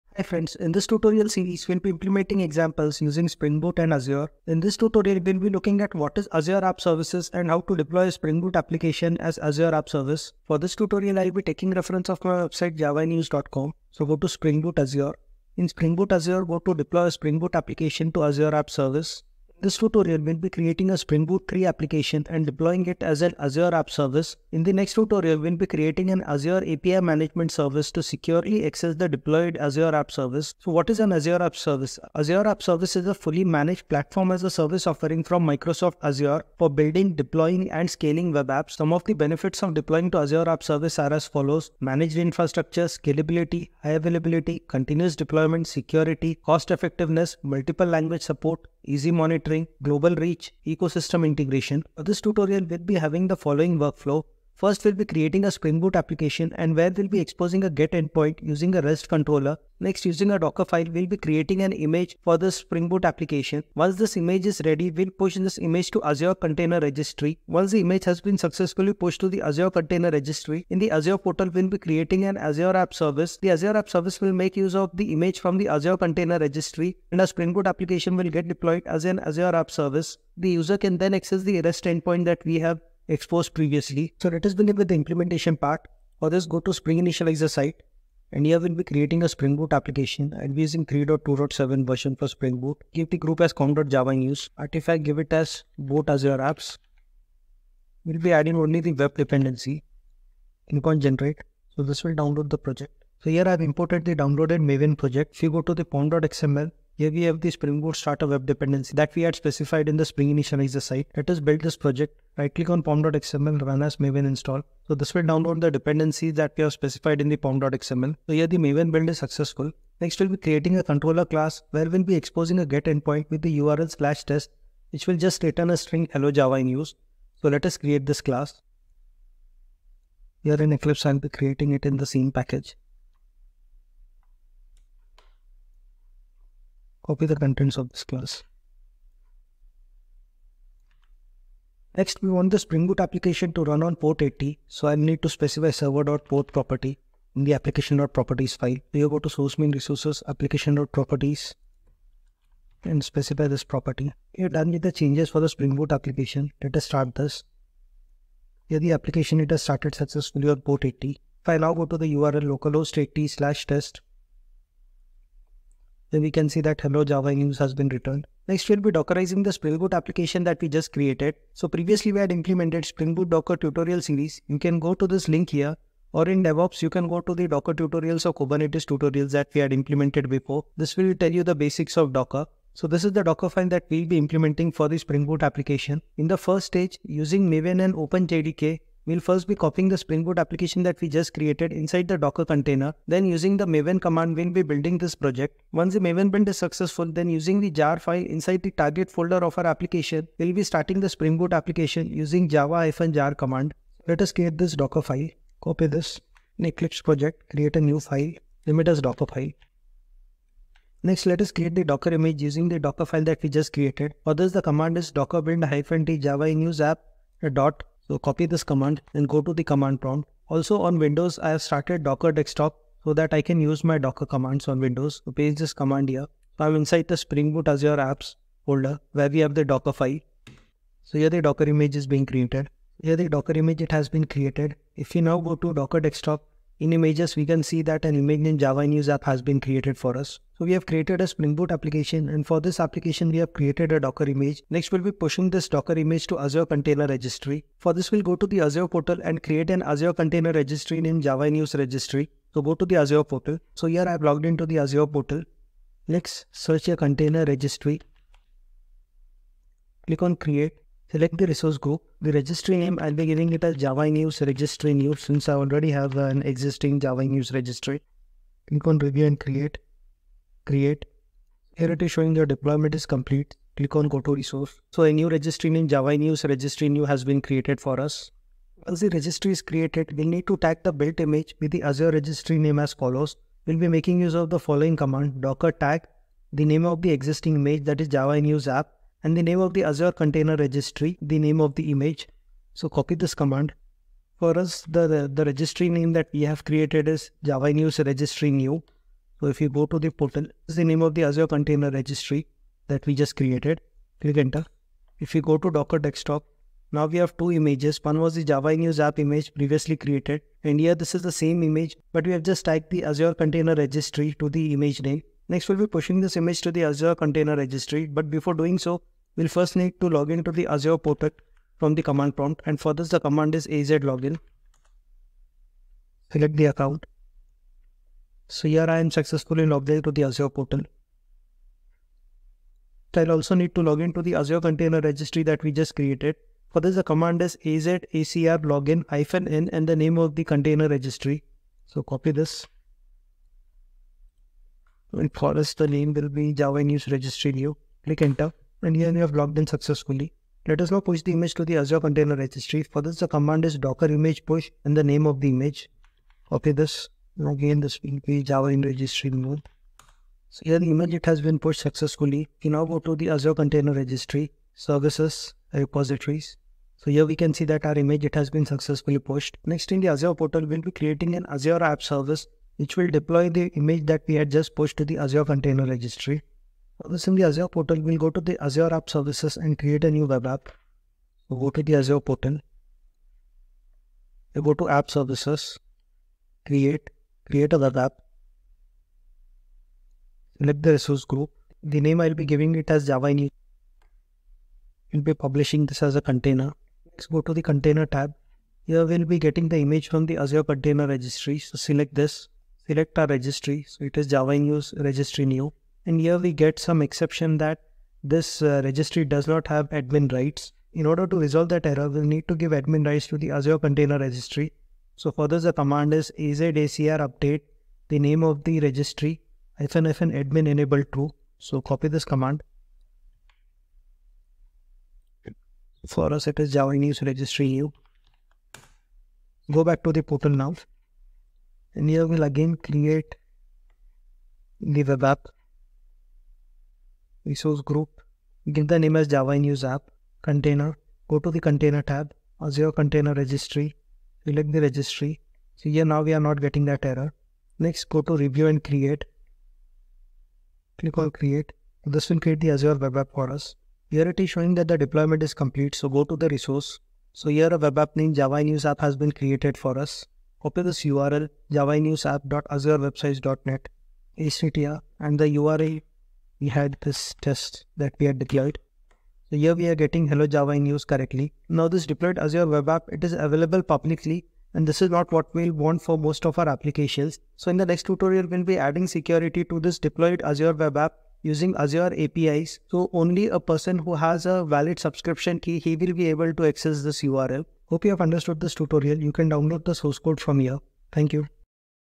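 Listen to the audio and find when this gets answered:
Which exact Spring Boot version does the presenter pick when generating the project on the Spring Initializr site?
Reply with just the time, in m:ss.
1:30.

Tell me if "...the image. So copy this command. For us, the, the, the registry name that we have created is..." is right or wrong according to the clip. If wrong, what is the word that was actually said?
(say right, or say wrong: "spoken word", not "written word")
right.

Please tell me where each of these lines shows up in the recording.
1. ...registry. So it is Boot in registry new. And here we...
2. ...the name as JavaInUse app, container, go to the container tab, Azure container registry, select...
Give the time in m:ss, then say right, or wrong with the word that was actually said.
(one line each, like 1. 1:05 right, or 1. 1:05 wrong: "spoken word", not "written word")
1. 6:43 wrong: "Java", not "Boot"
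2. 7:18 right.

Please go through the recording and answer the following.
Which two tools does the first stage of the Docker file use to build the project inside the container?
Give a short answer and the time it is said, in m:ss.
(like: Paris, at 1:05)
Maven and OpenJDK, at 3:07.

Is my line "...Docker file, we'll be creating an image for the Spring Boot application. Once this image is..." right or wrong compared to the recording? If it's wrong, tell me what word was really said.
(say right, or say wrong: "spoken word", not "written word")
right.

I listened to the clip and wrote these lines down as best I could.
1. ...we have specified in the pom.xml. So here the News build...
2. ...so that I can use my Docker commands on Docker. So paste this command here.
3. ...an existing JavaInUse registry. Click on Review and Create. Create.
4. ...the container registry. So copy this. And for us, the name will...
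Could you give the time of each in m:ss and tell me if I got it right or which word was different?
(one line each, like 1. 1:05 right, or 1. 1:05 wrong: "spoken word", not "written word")
1. 1:56 wrong: "Maven", not "News"
2. 3:43 wrong: "Windows", not "Docker"
3. 4:26 right
4. 5:40 right.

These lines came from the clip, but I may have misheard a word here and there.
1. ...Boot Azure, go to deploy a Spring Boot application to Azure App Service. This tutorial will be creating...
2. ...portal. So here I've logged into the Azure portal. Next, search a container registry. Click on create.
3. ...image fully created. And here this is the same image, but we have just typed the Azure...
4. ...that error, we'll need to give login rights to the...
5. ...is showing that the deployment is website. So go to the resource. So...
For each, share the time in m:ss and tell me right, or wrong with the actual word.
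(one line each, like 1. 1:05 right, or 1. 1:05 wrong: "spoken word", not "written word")
1. 0:15 right
2. 4:13 right
3. 5:09 wrong: "previously", not "fully"
4. 6:51 wrong: "admin", not "login"
5. 7:34 wrong: "complete", not "website".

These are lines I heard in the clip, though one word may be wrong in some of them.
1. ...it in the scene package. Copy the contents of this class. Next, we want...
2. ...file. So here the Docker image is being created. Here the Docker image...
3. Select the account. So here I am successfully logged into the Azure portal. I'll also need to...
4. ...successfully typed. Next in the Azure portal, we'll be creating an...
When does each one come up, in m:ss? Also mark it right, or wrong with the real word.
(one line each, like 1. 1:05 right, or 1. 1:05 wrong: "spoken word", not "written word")
1. 2:11 right
2. 3:49 right
3. 5:26 right
4. 6:08 wrong: "pushed", not "typed".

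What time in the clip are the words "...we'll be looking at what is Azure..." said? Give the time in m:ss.
0:05.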